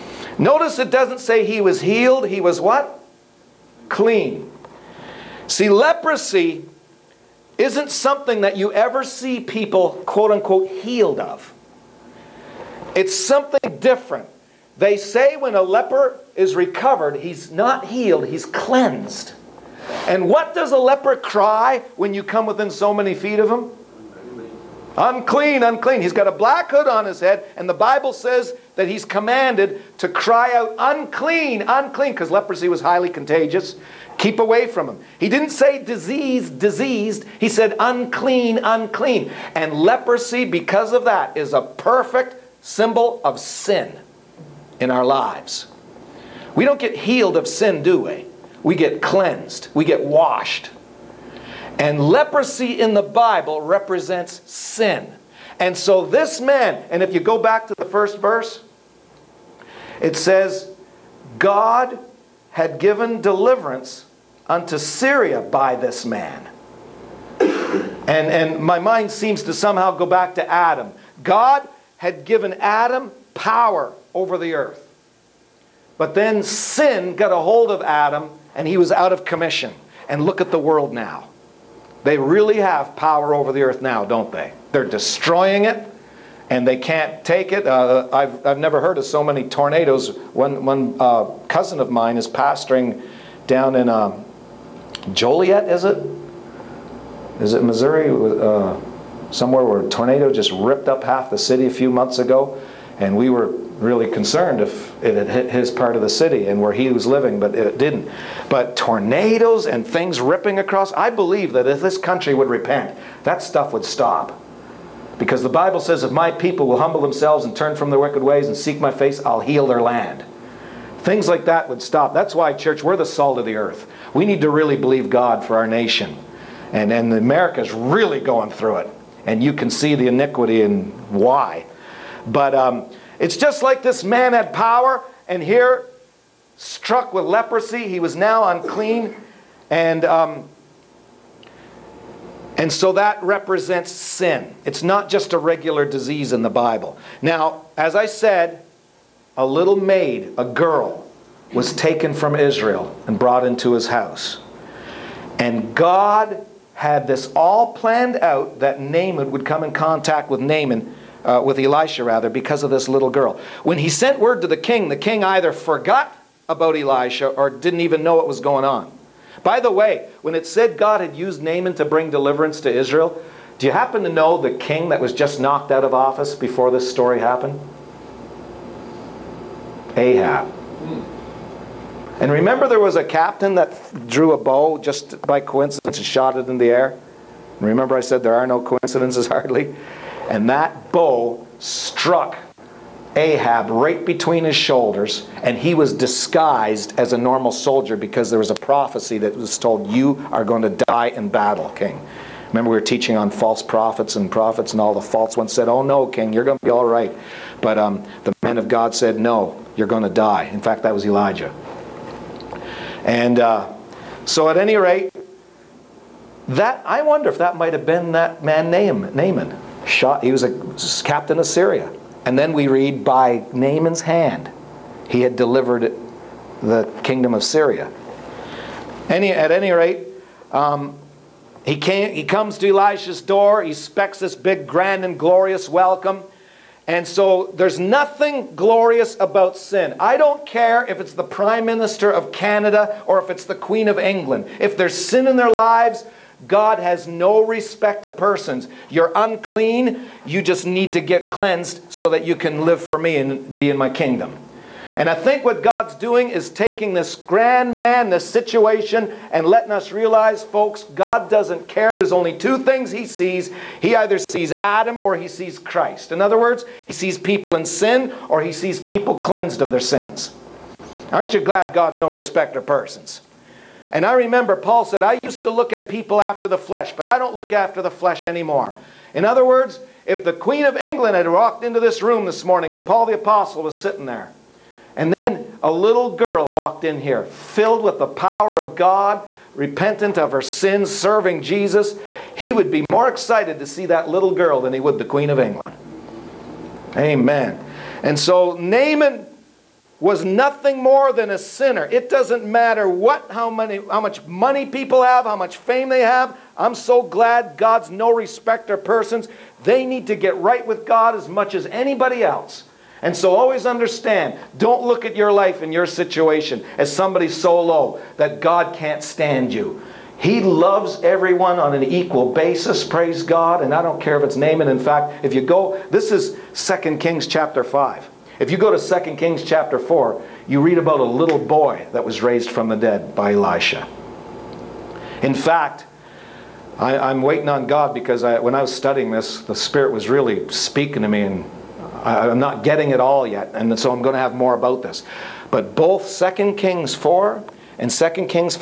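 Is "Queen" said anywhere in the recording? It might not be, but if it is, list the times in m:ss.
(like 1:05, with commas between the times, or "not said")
4:03, 4:40, 4:55.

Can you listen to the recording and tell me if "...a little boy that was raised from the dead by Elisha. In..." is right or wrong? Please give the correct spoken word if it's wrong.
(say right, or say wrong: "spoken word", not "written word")
right.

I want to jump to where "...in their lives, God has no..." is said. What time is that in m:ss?
4:05.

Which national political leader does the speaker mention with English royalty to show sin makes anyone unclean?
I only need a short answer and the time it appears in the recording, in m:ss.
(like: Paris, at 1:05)
Prime Minister of Canada, at 4:01.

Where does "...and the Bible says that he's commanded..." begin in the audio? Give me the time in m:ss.
0:27.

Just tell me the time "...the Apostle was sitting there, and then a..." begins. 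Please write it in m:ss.
4:43.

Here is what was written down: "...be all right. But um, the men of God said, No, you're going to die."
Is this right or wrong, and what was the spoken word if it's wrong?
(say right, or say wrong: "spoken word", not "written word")
right.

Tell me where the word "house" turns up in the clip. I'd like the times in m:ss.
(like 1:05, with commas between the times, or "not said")
2:33.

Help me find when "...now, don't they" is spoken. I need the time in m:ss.
1:23.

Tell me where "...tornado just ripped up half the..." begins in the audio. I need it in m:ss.
1:39.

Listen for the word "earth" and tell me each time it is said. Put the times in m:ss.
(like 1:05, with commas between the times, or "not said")
1:14, 1:23, 2:03.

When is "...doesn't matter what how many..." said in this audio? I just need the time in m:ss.
5:02.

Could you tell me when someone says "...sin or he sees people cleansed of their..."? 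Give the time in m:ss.
4:27.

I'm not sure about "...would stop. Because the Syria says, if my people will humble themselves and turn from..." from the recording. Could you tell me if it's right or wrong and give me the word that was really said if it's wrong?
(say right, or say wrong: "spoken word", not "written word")
wrong: "Bible", not "Syria".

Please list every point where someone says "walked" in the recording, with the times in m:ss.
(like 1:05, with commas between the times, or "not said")
4:41, 4:46.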